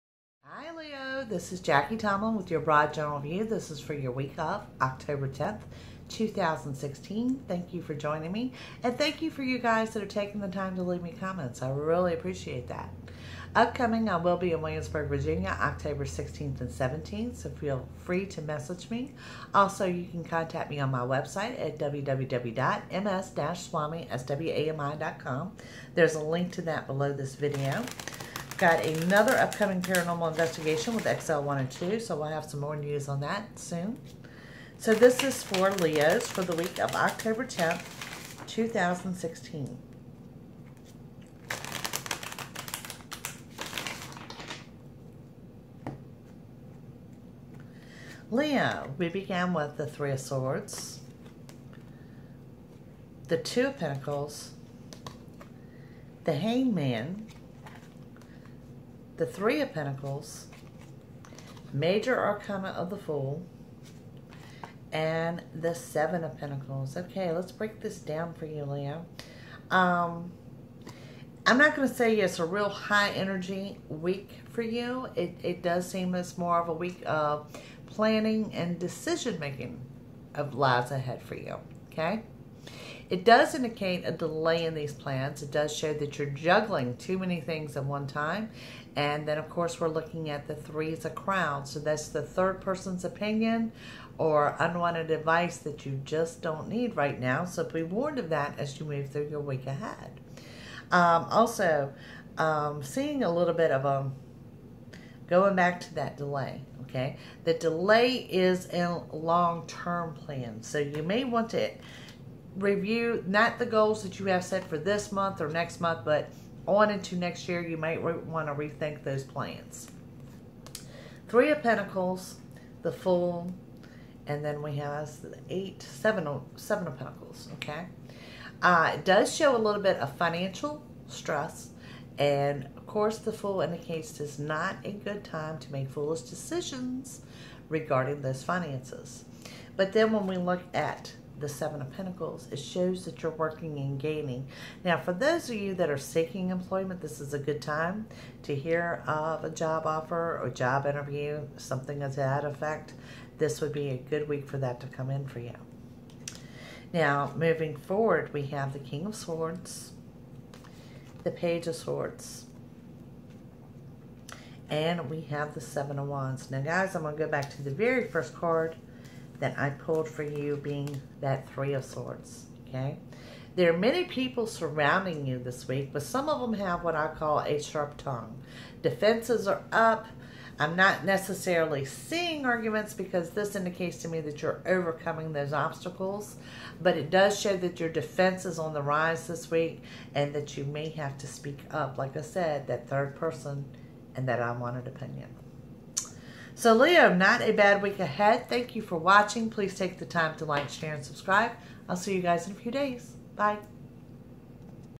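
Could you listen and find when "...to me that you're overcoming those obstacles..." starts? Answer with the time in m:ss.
3:04.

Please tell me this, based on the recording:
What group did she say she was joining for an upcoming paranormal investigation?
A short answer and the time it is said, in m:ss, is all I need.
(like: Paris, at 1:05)
XL1 and 2, at 0:31.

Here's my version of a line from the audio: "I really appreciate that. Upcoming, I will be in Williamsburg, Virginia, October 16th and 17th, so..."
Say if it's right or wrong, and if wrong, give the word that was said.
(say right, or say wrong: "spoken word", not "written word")
right.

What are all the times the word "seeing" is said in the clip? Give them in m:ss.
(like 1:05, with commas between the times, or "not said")
1:42, 3:01.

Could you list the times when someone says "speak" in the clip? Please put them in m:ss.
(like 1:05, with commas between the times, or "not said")
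3:11.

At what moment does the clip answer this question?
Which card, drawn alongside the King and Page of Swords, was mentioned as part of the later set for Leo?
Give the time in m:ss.
2:45.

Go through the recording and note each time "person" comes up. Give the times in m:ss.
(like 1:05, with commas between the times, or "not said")
1:32, 3:13.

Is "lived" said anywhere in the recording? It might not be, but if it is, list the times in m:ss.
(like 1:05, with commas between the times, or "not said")
not said.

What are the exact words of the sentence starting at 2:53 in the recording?
There are many people surrounding you this week, but some of them have what I call a sharp tongue.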